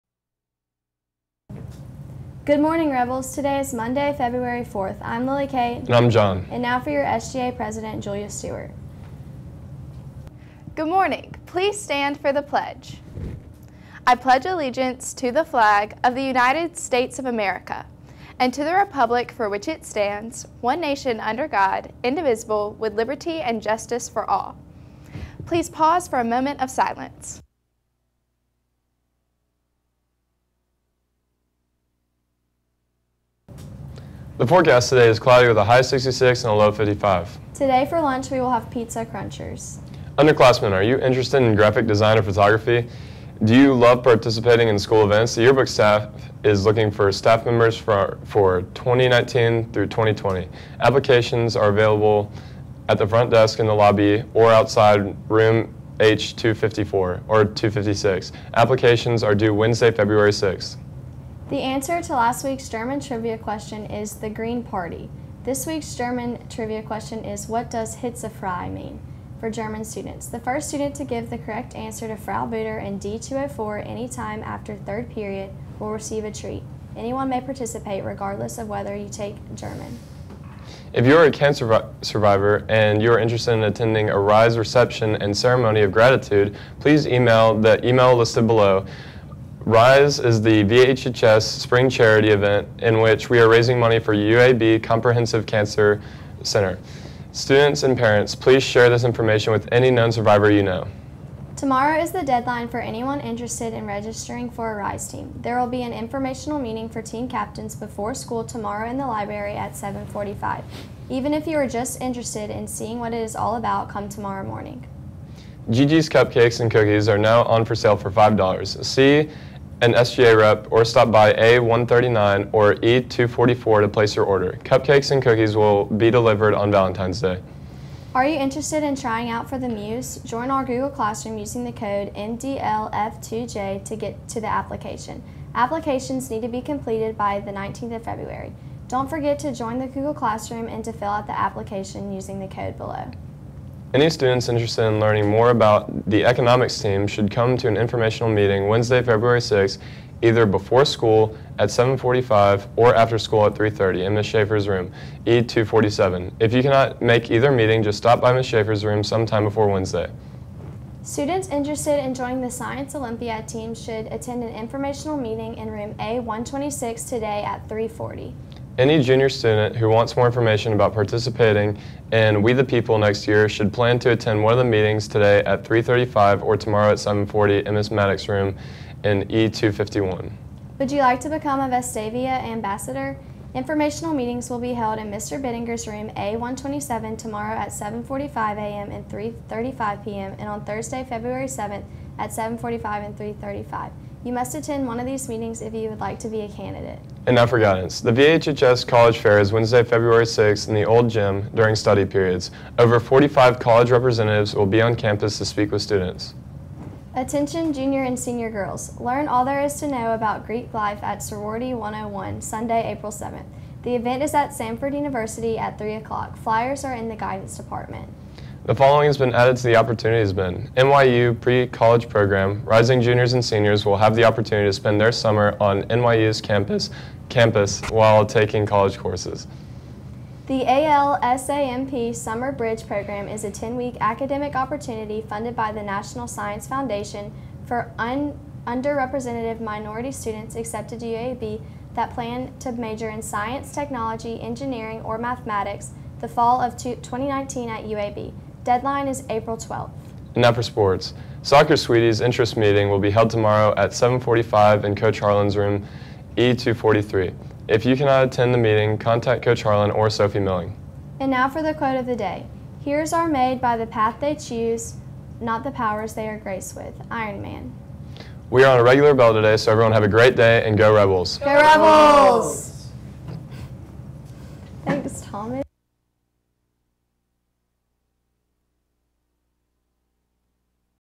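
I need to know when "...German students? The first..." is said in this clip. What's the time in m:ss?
1:09.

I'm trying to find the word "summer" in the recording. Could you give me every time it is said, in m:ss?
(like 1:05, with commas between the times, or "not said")
3:45, 3:52.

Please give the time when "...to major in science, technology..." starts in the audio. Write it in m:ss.
4:02.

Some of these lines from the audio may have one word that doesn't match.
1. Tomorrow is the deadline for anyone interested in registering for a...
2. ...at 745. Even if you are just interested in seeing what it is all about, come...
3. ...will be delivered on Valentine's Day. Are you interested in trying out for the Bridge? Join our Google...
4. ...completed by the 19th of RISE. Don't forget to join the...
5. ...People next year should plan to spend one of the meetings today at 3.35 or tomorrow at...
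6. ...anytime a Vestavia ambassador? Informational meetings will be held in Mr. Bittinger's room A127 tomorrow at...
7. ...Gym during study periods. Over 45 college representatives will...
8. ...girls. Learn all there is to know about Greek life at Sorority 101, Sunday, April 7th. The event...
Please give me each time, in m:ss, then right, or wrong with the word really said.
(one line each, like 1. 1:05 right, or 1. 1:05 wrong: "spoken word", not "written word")
1. 1:41 right
2. 1:49 right
3. 2:05 wrong: "Muse", not "Bridge"
4. 2:16 wrong: "February", not "RISE"
5. 2:52 wrong: "attend", not "spend"
6. 3:01 wrong: "become", not "anytime"
7. 3:21 right
8. 3:28 right.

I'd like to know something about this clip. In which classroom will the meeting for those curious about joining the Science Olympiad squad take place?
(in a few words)
A126.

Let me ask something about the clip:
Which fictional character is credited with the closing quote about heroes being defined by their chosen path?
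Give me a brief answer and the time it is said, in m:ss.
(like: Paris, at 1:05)
Iron Man, at 4:27.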